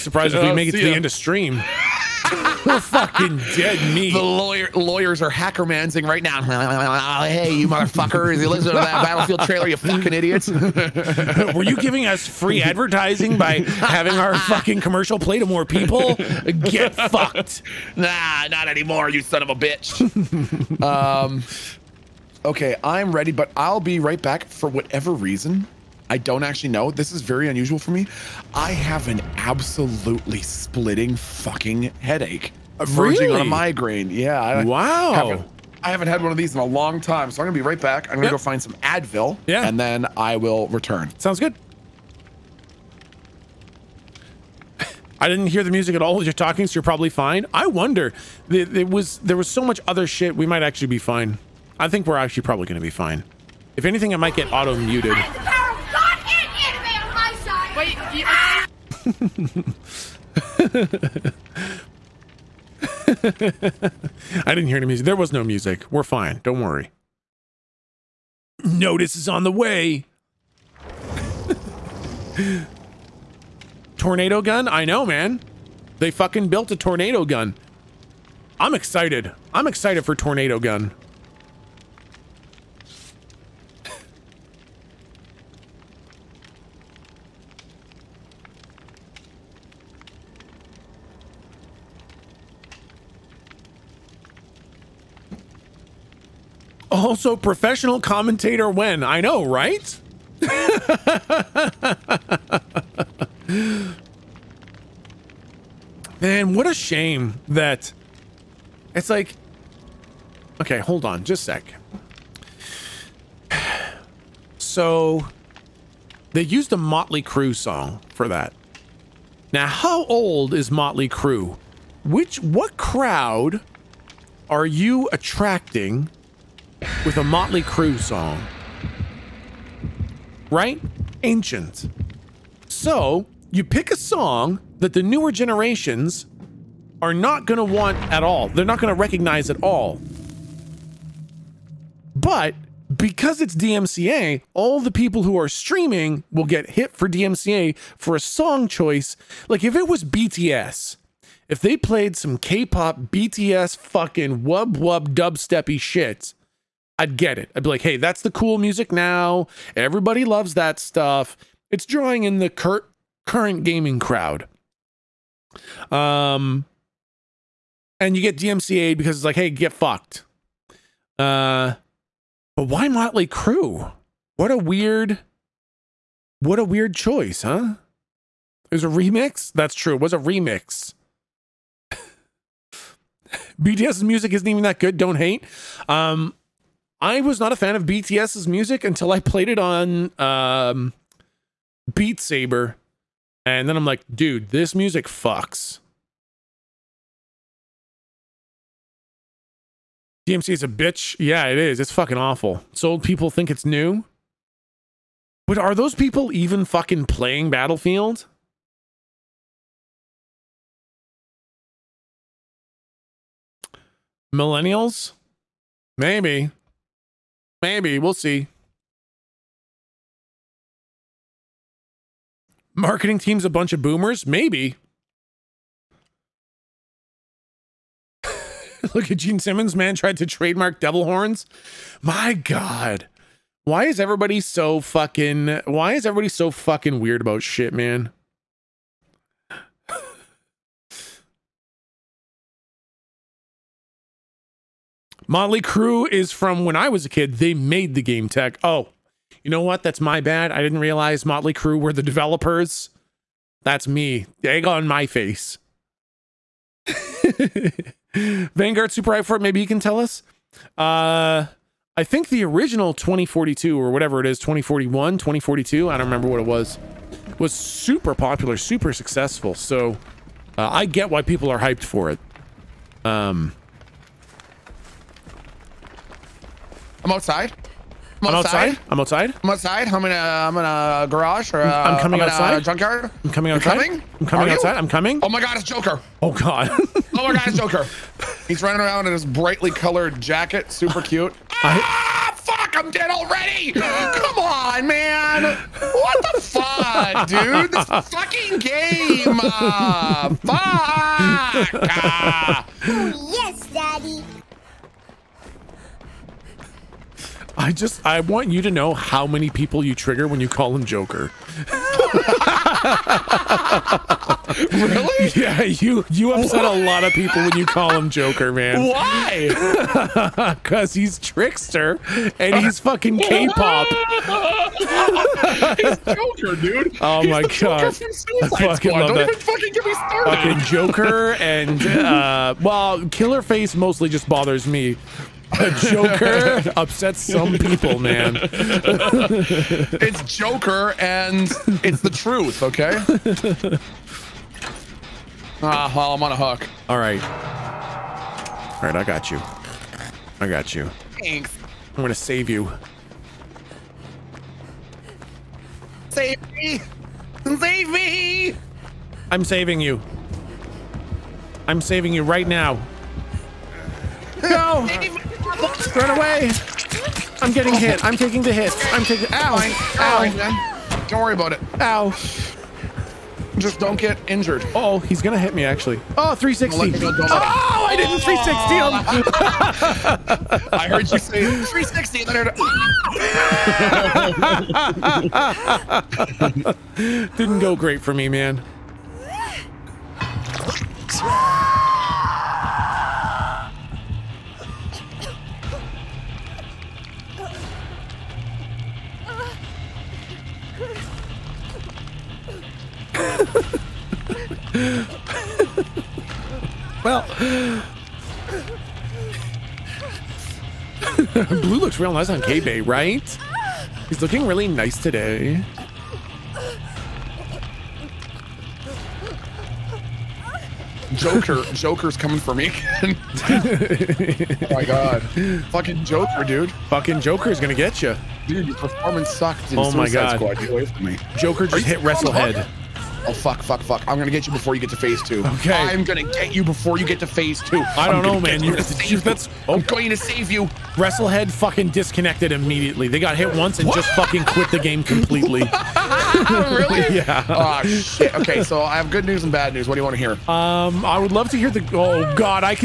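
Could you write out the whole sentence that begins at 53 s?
If anything, I might get auto-muted.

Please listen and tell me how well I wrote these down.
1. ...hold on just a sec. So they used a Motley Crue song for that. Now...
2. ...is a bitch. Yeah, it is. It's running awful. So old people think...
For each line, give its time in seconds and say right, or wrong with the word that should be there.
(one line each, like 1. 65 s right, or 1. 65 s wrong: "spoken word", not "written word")
1. 110 s right
2. 200 s wrong: "fucking", not "running".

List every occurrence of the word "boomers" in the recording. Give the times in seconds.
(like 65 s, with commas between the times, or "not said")
223 s.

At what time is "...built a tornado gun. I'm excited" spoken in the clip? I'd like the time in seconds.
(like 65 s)
76 s.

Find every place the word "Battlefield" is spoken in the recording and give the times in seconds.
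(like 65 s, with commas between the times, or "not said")
9 s, 207 s.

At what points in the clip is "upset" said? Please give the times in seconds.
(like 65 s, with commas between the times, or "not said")
316 s, 336 s.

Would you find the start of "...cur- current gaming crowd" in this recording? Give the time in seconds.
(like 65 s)
162 s.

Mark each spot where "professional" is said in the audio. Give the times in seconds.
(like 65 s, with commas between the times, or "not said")
97 s.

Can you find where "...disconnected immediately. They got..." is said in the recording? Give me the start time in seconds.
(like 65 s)
441 s.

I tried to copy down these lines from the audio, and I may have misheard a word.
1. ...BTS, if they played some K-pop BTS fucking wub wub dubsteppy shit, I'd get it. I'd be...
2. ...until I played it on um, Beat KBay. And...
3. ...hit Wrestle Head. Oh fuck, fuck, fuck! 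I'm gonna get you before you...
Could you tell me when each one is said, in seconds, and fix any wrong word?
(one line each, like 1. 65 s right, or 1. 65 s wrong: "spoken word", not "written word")
1. 150 s right
2. 188 s wrong: "Saber", not "KBay"
3. 431 s right.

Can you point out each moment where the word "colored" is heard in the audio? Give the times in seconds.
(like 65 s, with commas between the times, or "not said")
289 s.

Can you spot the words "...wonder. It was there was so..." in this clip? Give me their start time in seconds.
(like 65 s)
47 s.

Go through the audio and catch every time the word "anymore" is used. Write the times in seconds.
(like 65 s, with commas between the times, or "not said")
18 s.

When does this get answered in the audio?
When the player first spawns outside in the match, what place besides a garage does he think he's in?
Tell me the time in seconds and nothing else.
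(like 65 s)
282 s.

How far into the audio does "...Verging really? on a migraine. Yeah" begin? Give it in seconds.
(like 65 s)
32 s.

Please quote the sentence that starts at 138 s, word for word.
They're not going to recognize at all.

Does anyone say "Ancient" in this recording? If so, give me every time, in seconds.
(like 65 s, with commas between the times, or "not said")
131 s.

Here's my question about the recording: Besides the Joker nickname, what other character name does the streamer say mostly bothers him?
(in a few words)
Killer Face.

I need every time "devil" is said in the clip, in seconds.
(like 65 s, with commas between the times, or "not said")
230 s.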